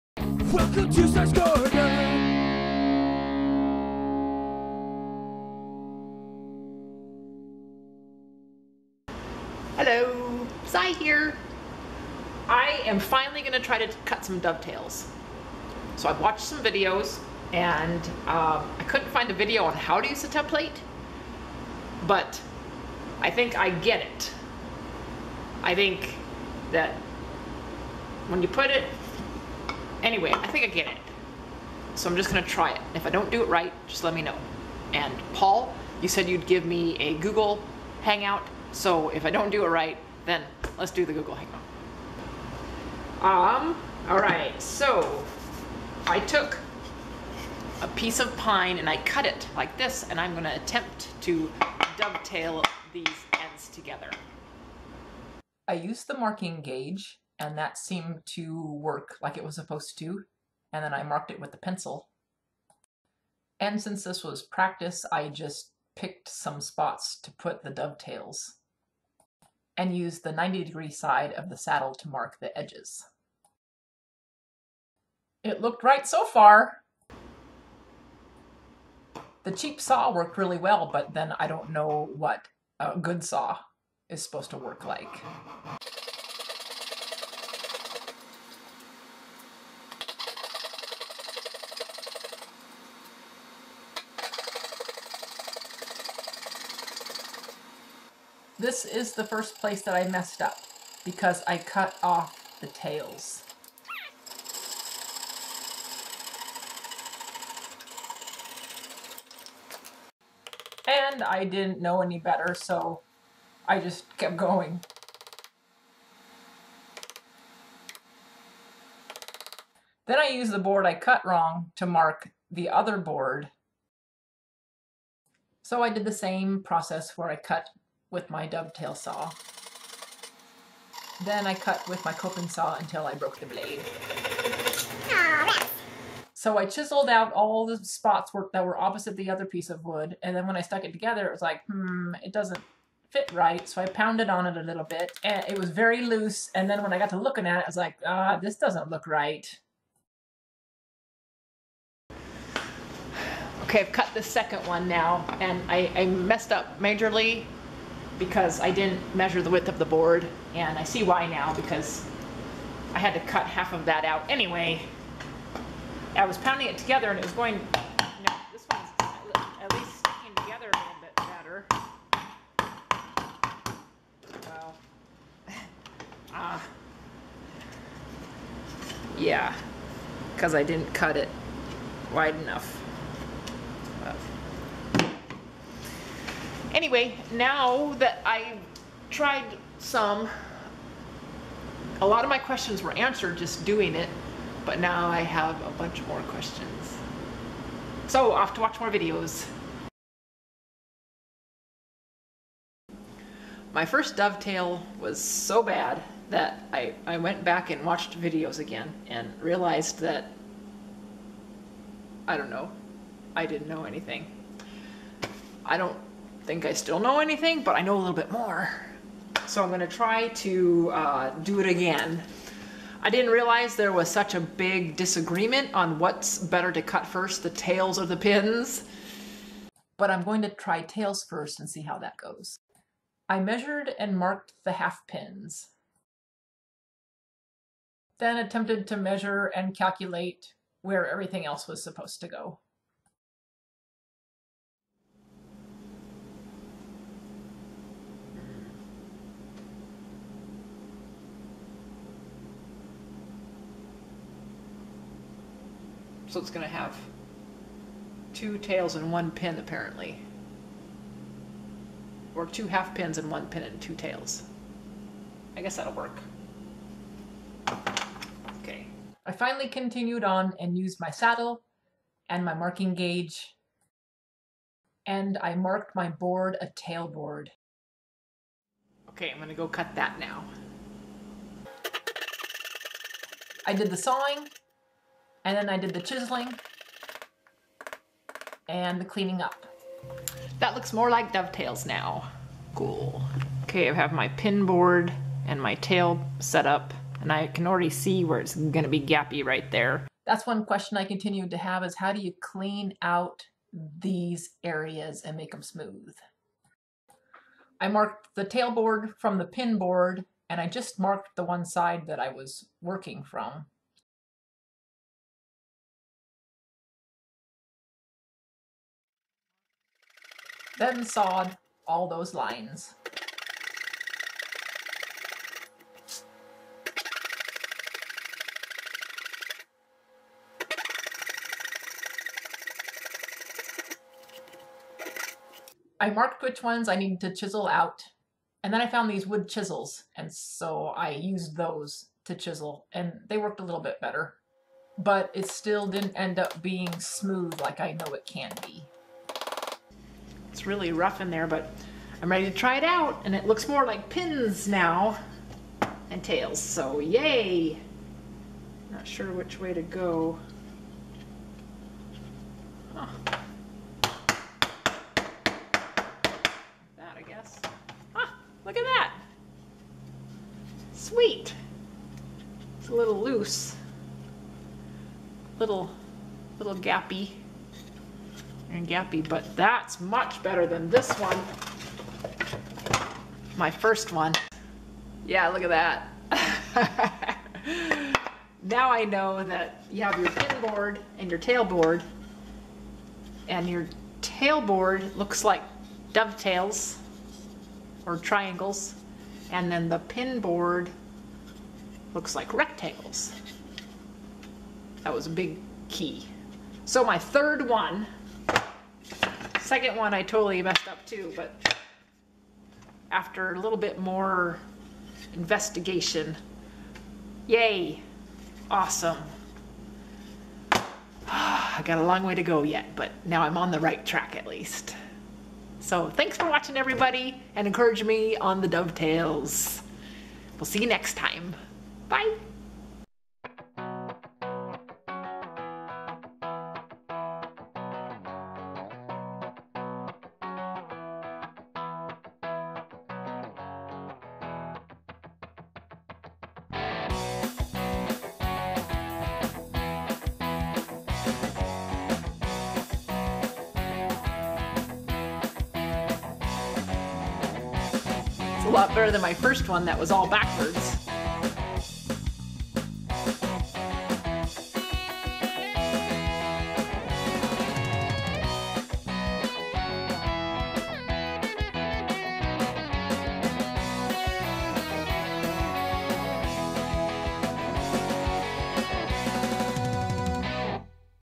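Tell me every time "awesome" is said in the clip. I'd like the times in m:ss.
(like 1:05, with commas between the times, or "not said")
6:58.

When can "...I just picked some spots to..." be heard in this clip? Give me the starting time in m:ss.
1:05.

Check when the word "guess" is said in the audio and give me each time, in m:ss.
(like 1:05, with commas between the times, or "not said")
4:25, 6:07.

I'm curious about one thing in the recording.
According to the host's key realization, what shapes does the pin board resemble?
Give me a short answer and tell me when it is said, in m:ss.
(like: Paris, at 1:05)
Rectangles, at 6:42.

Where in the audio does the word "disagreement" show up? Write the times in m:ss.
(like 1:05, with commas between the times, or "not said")
3:44.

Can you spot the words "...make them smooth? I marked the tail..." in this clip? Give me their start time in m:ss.
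5:05.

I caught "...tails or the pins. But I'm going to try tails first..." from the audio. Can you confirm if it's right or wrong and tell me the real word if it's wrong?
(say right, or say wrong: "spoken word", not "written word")
right.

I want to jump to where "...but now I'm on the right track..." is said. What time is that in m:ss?
7:02.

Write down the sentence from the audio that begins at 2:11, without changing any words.
Then I cut with my coping saw until I broke the blade.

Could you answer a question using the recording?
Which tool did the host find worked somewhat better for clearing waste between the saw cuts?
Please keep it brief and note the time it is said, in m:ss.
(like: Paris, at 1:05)
Wood chisels, at 5:39.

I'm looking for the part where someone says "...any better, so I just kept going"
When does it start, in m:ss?
1:52.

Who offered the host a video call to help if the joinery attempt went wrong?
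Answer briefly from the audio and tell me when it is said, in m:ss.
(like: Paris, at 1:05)
Paul, at 0:35.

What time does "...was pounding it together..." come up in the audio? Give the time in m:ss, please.
2:46.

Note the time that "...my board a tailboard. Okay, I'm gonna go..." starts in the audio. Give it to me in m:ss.
4:35.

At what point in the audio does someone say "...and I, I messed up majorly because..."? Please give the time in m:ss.
2:35.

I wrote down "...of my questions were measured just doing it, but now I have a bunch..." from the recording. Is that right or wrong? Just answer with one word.
wrong.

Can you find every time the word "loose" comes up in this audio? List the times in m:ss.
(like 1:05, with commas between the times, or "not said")
2:26, 6:13.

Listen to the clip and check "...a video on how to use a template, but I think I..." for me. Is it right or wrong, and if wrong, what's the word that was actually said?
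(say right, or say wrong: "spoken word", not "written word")
right.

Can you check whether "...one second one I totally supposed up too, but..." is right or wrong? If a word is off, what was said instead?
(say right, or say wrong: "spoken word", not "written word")
wrong: "messed", not "supposed".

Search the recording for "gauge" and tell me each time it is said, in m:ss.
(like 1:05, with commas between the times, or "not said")
0:56, 4:32.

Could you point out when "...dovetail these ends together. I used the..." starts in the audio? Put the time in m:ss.
0:51.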